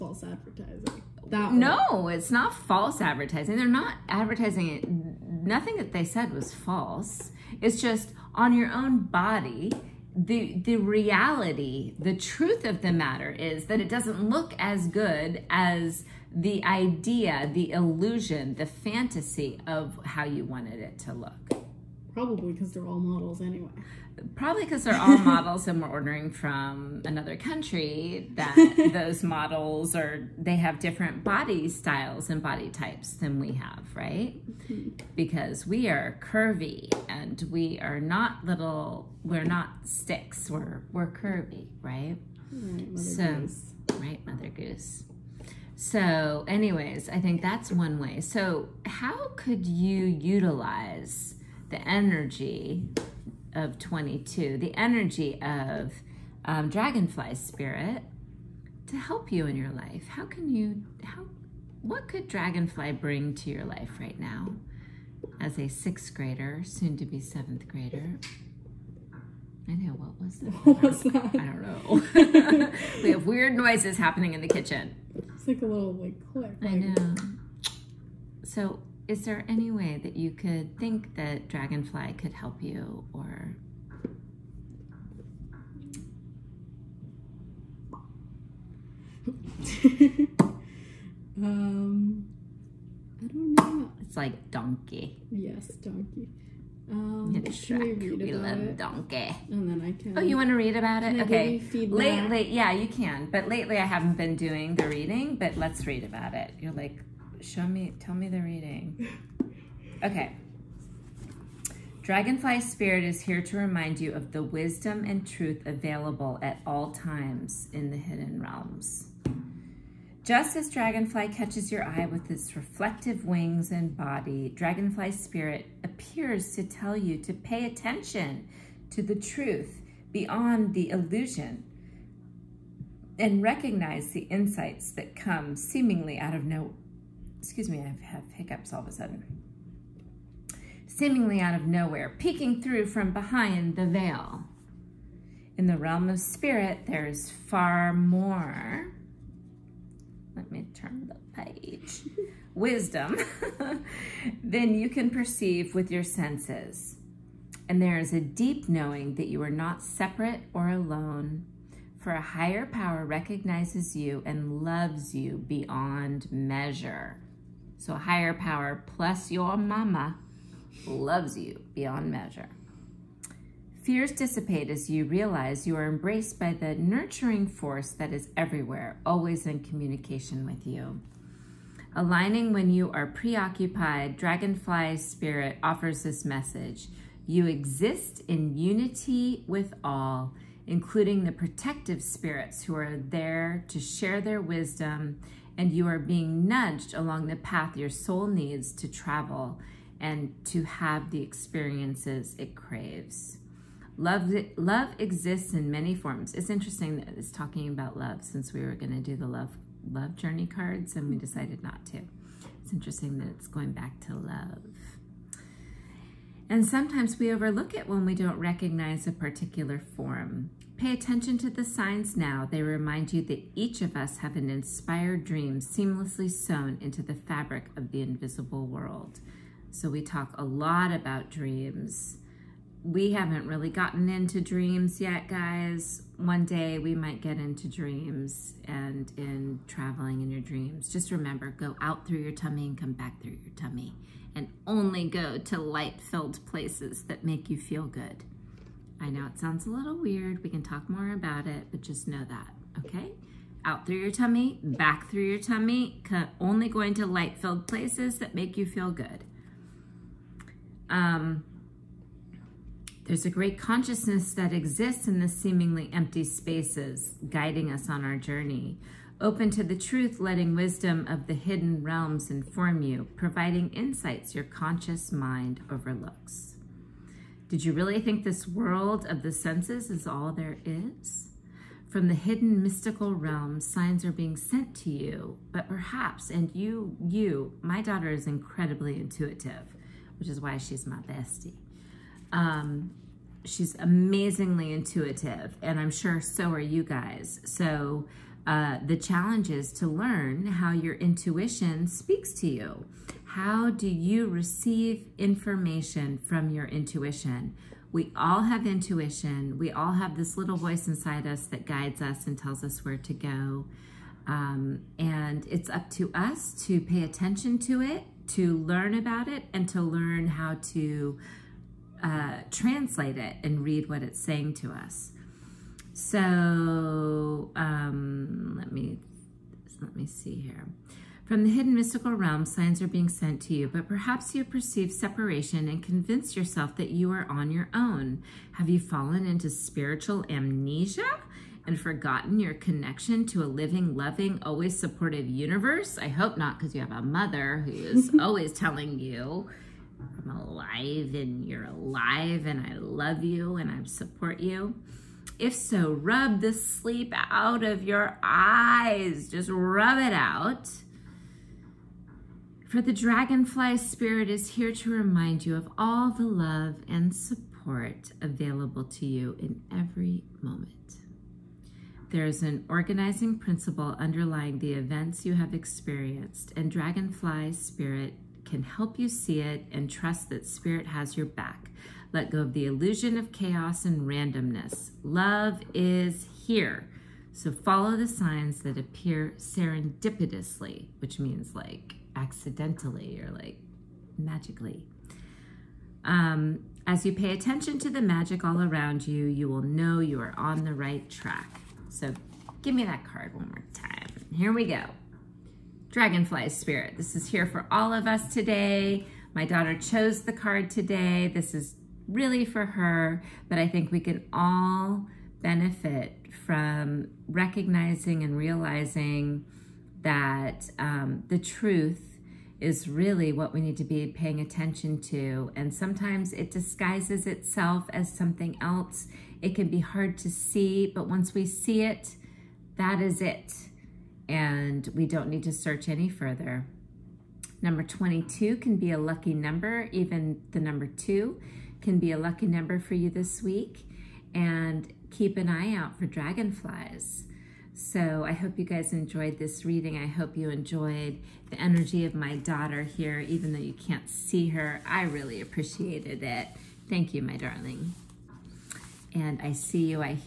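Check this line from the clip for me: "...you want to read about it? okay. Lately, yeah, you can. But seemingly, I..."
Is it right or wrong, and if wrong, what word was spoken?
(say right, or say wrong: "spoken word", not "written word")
wrong: "lately", not "seemingly".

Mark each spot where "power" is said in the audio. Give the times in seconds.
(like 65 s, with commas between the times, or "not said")
162 s, 168 s.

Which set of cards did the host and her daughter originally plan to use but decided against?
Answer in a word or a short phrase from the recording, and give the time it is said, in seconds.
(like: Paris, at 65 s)
love journey cards, at 209 s.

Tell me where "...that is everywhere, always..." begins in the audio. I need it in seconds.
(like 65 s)
177 s.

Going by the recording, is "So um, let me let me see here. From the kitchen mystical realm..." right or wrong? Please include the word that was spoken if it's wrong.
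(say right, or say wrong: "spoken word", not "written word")
wrong: "hidden", not "kitchen".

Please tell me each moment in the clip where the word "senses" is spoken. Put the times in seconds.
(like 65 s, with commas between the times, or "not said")
156 s, 279 s.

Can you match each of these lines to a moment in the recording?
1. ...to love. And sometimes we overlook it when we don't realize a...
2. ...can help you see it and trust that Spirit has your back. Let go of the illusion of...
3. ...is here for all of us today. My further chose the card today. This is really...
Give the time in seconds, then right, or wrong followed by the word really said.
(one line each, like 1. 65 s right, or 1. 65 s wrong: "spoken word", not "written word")
1. 214 s wrong: "recognize", not "realize"
2. 378 s right
3. 407 s wrong: "daughter", not "further".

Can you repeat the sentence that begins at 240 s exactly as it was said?
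Just remember, go out through your tummy and come back through your tummy.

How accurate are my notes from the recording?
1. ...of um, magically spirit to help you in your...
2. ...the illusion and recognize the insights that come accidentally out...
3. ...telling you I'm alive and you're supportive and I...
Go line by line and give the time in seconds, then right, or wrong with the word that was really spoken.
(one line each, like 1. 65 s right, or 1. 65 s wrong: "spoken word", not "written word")
1. 55 s wrong: "dragonfly", not "magically"
2. 130 s wrong: "seemingly", not "accidentally"
3. 348 s wrong: "alive", not "supportive".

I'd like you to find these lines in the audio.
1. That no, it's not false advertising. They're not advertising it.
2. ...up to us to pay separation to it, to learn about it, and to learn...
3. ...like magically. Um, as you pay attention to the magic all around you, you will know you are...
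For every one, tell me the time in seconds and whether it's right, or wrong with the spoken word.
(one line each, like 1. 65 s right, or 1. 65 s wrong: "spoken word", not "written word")
1. 1 s right
2. 315 s wrong: "attention", not "separation"
3. 393 s right.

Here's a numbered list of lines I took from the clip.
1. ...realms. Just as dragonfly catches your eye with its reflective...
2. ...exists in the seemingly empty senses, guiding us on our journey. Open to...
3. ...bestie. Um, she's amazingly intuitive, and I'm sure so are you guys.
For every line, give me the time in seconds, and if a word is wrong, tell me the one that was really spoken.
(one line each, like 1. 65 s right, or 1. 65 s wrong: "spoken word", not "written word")
1. 118 s right
2. 264 s wrong: "spaces", not "senses"
3. 290 s right.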